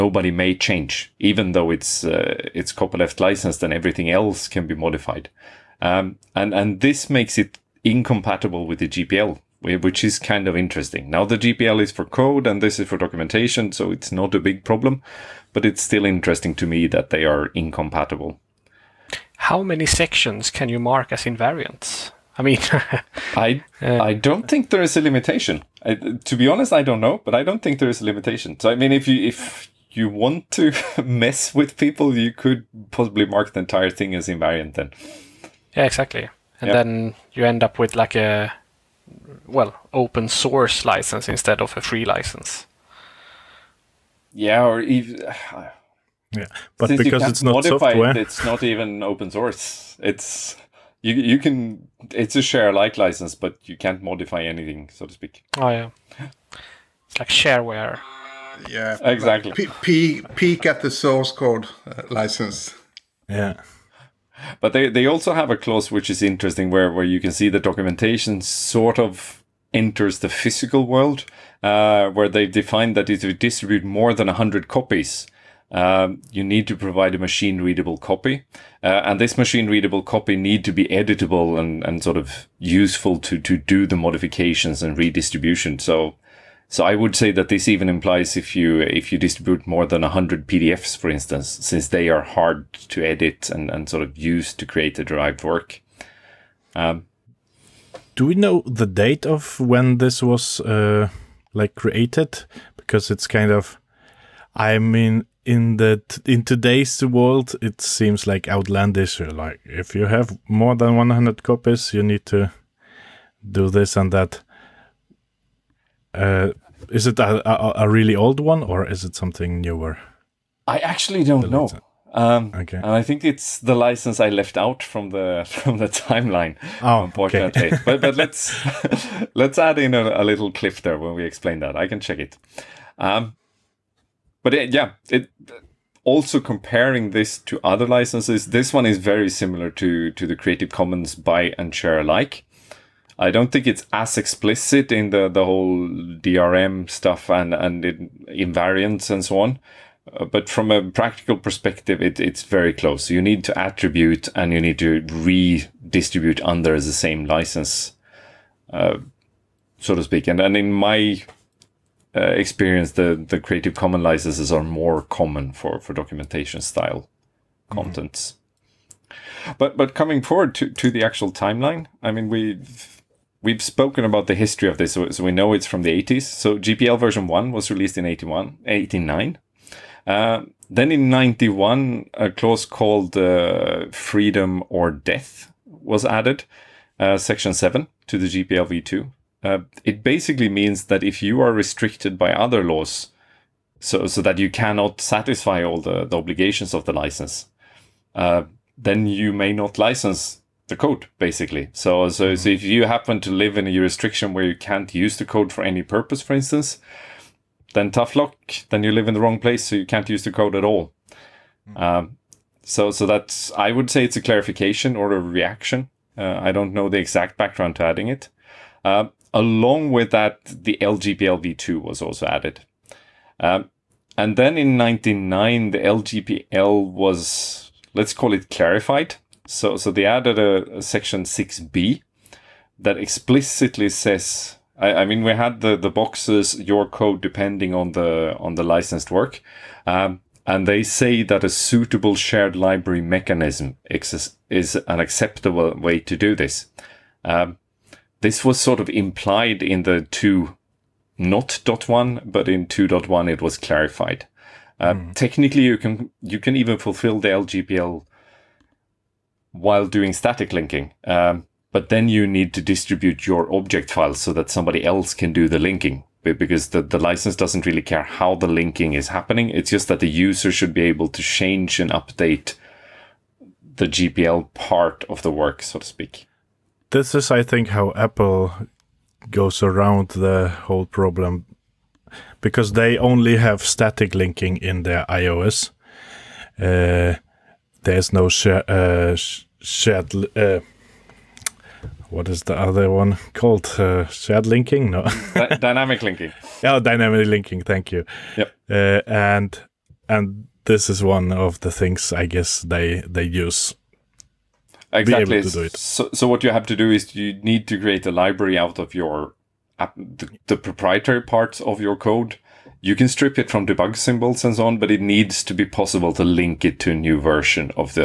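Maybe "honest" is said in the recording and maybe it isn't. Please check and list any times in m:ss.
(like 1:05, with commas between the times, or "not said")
0:26.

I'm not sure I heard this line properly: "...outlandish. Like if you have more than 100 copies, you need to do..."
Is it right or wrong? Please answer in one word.
right.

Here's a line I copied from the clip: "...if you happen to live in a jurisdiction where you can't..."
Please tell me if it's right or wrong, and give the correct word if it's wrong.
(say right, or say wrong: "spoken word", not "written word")
right.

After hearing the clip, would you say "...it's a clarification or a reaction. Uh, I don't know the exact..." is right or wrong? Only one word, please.
right.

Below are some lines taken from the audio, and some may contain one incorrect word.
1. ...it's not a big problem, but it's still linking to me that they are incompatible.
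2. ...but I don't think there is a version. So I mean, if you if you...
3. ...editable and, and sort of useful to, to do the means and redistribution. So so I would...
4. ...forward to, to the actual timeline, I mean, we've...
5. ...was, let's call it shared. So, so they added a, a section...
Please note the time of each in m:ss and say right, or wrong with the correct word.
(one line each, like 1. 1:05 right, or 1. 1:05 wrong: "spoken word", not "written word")
1. 0:13 wrong: "interesting", not "linking"
2. 0:27 wrong: "limitation", not "version"
3. 1:20 wrong: "modifications", not "means"
4. 2:50 right
5. 3:46 wrong: "clarified", not "shared".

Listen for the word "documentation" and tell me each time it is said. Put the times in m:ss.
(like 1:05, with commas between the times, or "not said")
0:12, 1:07, 2:45.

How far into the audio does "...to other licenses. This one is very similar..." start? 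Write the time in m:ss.
2:17.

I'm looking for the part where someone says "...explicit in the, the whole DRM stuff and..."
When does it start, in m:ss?
2:24.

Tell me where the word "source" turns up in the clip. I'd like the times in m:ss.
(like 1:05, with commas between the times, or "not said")
0:40, 0:49, 1:00.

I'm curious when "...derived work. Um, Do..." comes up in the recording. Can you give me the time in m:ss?
1:35.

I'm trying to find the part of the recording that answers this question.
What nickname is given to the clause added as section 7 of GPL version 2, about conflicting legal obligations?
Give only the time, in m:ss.
3:03.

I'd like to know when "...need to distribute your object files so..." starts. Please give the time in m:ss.
4:22.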